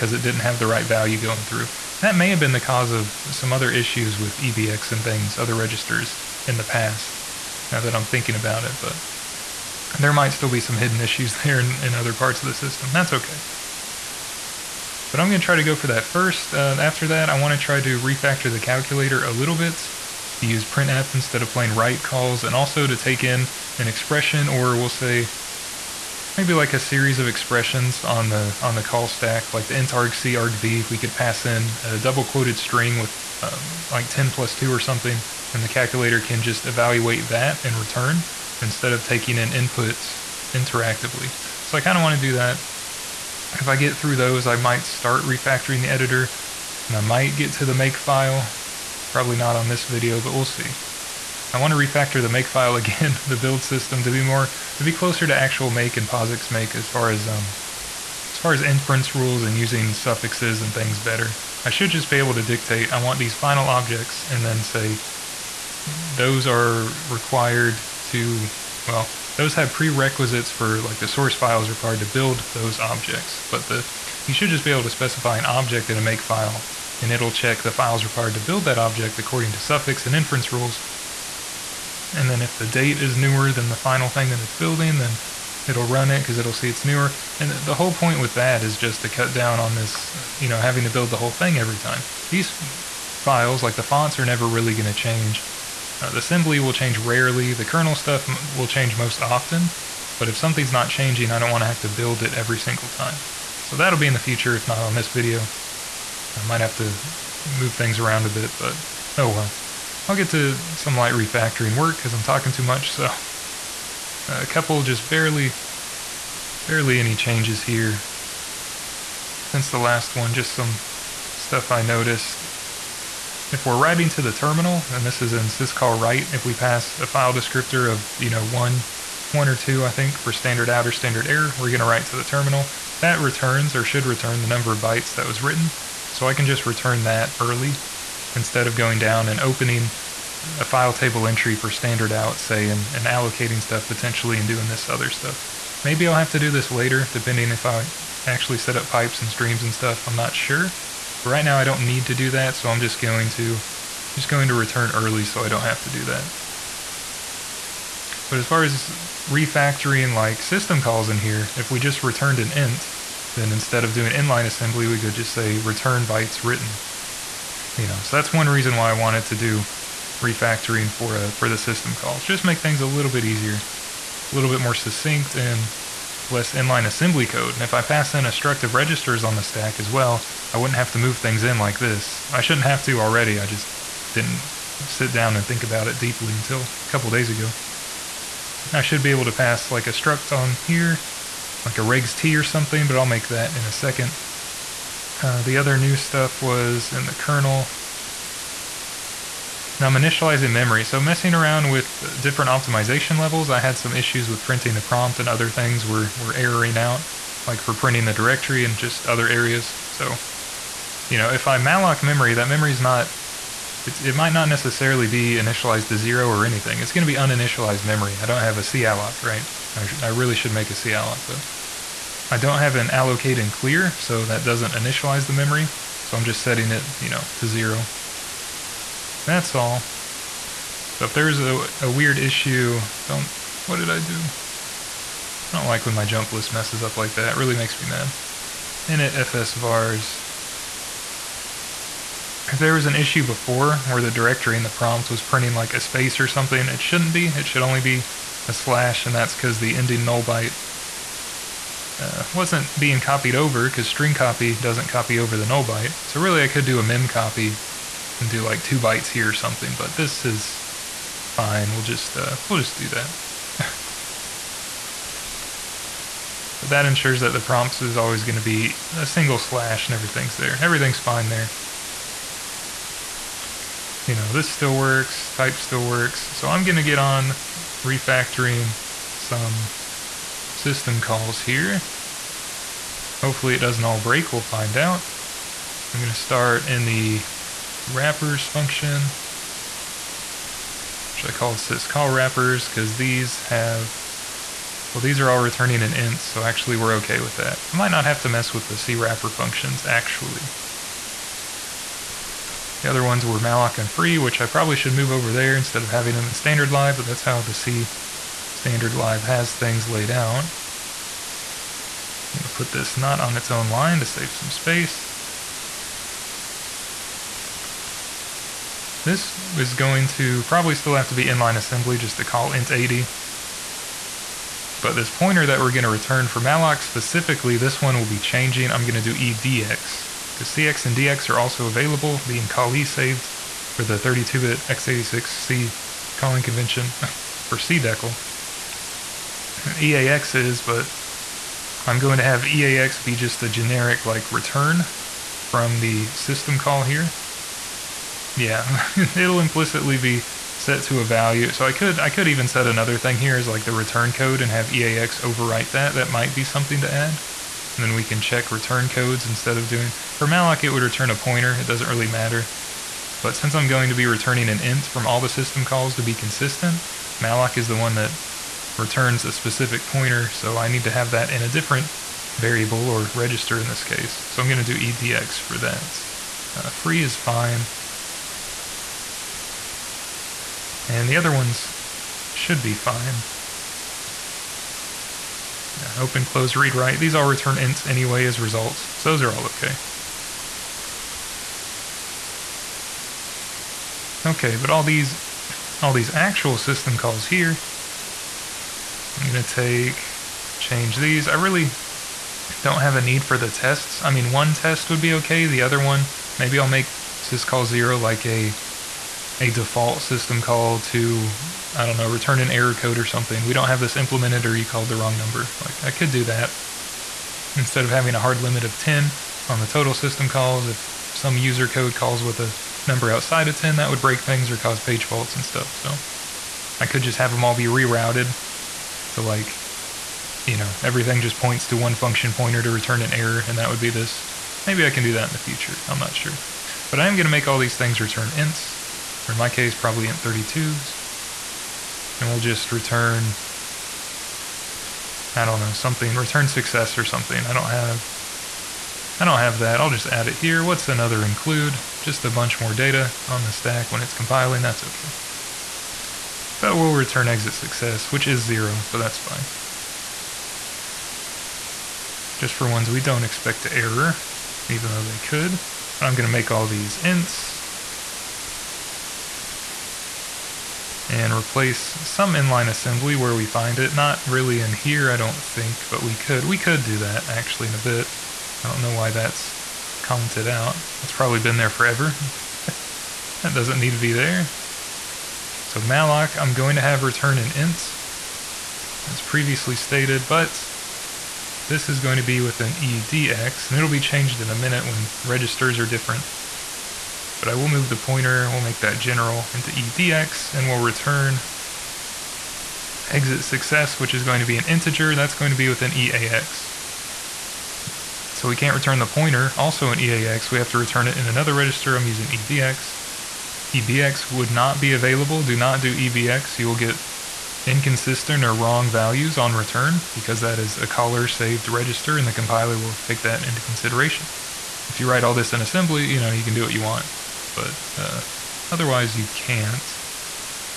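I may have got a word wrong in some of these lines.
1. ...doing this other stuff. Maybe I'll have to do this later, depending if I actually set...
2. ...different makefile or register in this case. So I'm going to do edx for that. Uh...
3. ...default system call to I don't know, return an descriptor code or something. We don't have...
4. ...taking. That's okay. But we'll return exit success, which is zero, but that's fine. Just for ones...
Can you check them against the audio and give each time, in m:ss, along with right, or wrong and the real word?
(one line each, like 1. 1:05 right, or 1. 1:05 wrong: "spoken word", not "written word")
1. 2:24 right
2. 6:11 wrong: "variable", not "makefile"
3. 6:49 wrong: "error", not "descriptor"
4. 7:34 wrong: "compiling", not "taking".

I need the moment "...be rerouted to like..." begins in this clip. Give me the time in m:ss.
7:07.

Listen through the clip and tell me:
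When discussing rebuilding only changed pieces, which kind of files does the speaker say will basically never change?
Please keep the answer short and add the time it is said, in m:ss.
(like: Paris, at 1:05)
the fonts, at 1:33.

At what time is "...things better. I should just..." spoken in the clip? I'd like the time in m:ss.
1:00.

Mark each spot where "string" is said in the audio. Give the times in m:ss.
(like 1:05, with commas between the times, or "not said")
0:32, 4:13.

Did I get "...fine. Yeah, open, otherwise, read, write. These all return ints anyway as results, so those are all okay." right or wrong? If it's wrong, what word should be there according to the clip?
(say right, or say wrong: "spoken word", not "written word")
wrong: "close", not "otherwise".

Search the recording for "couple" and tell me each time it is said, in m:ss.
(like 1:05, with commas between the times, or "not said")
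1:54, 3:06.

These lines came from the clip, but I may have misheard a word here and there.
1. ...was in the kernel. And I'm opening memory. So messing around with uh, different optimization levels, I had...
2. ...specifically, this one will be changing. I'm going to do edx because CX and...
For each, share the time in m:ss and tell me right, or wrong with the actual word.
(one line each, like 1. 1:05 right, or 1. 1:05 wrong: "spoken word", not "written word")
1. 3:16 wrong: "initializing", not "opening"
2. 5:26 right.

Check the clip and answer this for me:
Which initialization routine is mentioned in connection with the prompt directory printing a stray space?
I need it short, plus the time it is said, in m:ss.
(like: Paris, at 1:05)
Init fs vars, at 3:58.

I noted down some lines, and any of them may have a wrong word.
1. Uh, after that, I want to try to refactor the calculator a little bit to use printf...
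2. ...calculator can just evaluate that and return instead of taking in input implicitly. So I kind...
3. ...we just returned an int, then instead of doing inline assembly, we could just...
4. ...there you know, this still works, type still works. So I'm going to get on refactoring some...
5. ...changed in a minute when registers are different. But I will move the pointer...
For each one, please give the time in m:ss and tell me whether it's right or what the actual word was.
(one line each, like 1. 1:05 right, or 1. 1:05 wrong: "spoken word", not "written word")
1. 0:16 right
2. 0:35 wrong: "interactively", not "implicitly"
3. 2:41 right
4. 4:31 right
5. 8:13 right.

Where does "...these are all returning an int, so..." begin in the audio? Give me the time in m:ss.
4:55.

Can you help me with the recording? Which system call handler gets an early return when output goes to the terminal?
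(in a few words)
syscall write.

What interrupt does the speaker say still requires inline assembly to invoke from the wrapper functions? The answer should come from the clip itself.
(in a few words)
int80.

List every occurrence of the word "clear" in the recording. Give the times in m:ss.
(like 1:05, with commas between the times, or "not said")
3:43.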